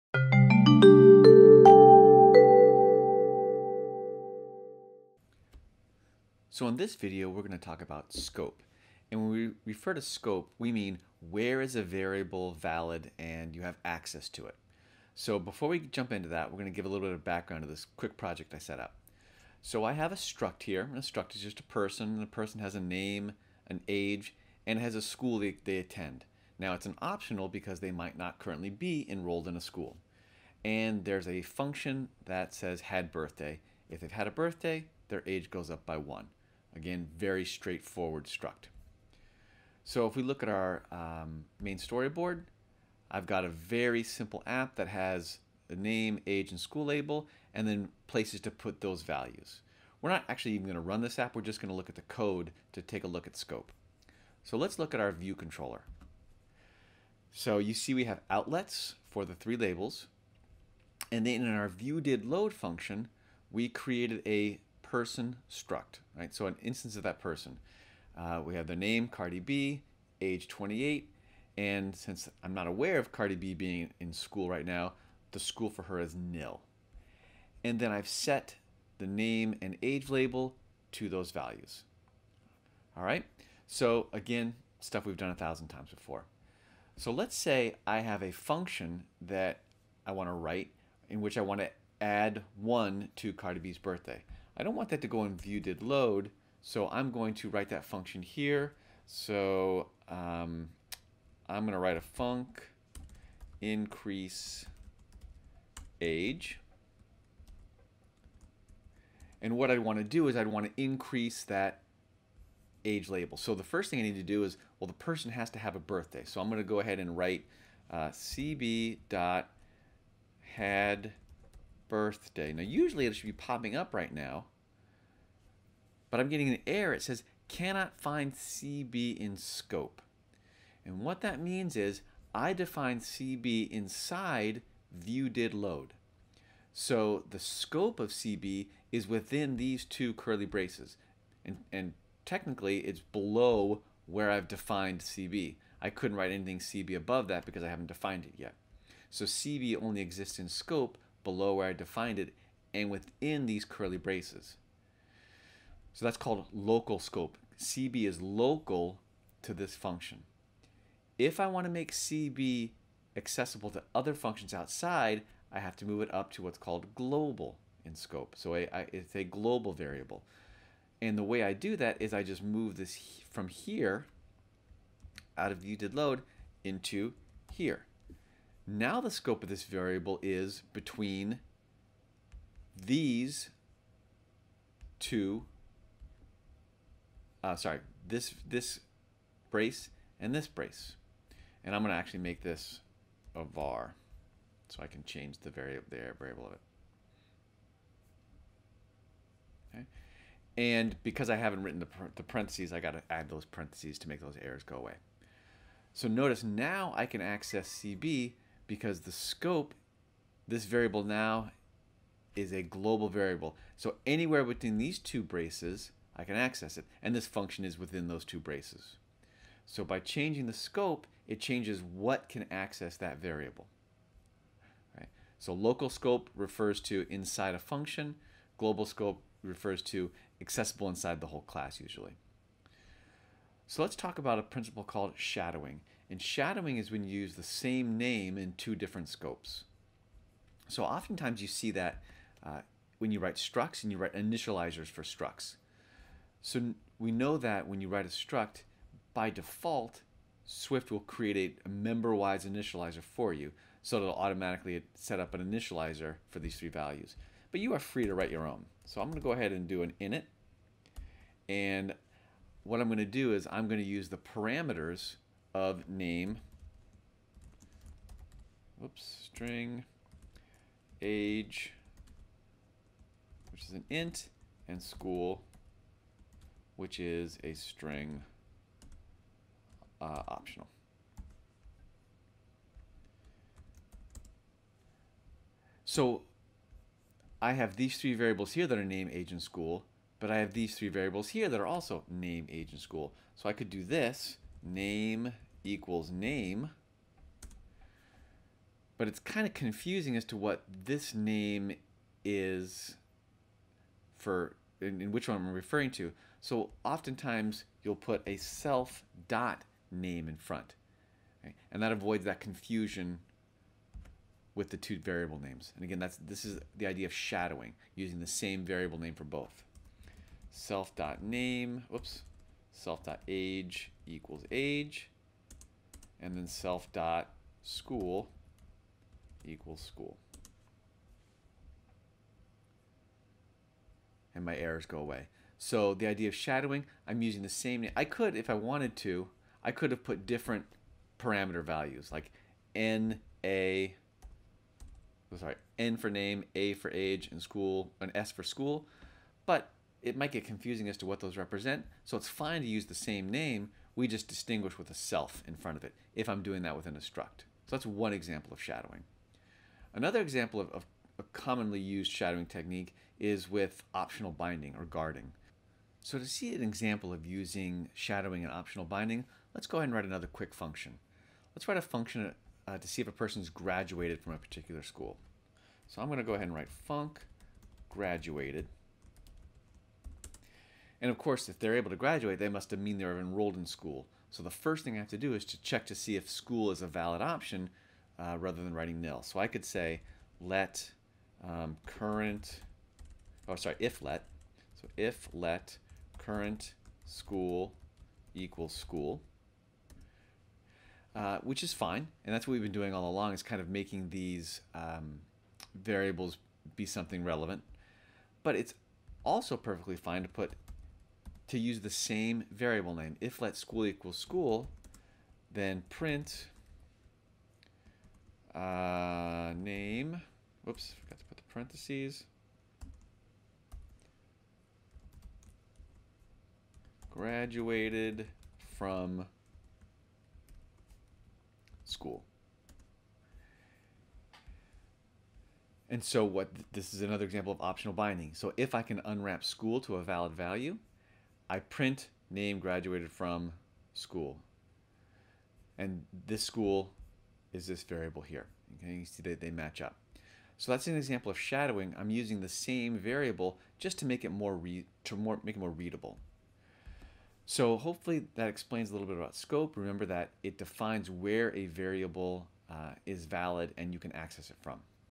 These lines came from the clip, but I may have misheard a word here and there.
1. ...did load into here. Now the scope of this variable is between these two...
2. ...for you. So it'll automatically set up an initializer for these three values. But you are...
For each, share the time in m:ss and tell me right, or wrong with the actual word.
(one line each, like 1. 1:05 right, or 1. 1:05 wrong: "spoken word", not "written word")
1. 2:55 right
2. 4:13 right.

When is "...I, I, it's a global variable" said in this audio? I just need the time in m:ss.
2:48.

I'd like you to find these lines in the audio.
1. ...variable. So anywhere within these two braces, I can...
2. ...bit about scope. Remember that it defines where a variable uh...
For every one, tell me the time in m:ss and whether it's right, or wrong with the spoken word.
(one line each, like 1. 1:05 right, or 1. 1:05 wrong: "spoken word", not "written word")
1. 3:33 right
2. 7:39 right.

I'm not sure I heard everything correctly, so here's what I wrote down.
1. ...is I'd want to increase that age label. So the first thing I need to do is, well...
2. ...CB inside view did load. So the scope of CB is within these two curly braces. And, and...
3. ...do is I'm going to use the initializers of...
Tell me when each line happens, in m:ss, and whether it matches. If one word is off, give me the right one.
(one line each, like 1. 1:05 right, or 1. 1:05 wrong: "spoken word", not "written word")
1. 1:50 right
2. 2:12 right
3. 4:23 wrong: "parameters", not "initializers".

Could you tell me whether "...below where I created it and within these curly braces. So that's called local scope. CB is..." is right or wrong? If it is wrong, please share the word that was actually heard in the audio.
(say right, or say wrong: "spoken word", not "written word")
wrong: "defined", not "created".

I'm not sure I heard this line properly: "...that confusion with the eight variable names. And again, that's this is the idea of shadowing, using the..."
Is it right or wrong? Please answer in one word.
wrong.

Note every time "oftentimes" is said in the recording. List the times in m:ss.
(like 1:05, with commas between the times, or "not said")
4:00, 5:06.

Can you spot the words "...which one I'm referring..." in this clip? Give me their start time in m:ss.
5:05.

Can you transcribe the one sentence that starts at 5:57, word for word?
So that's one example of shadowing.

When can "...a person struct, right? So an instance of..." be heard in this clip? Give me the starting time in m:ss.
1:04.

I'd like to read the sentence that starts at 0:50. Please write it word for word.
We're not actually even going to run this app.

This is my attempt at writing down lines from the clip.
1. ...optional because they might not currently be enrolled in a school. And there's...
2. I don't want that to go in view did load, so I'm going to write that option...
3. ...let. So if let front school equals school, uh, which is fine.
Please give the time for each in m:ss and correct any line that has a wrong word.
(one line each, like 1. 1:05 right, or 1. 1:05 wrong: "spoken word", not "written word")
1. 0:27 right
2. 1:34 wrong: "function", not "option"
3. 6:34 wrong: "current", not "front".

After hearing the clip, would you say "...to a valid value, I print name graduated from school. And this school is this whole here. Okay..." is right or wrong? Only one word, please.
wrong.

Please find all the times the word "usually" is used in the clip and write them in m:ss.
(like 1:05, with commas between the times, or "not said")
2:02, 3:51.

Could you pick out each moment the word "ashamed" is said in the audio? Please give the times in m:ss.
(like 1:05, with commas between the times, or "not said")
not said.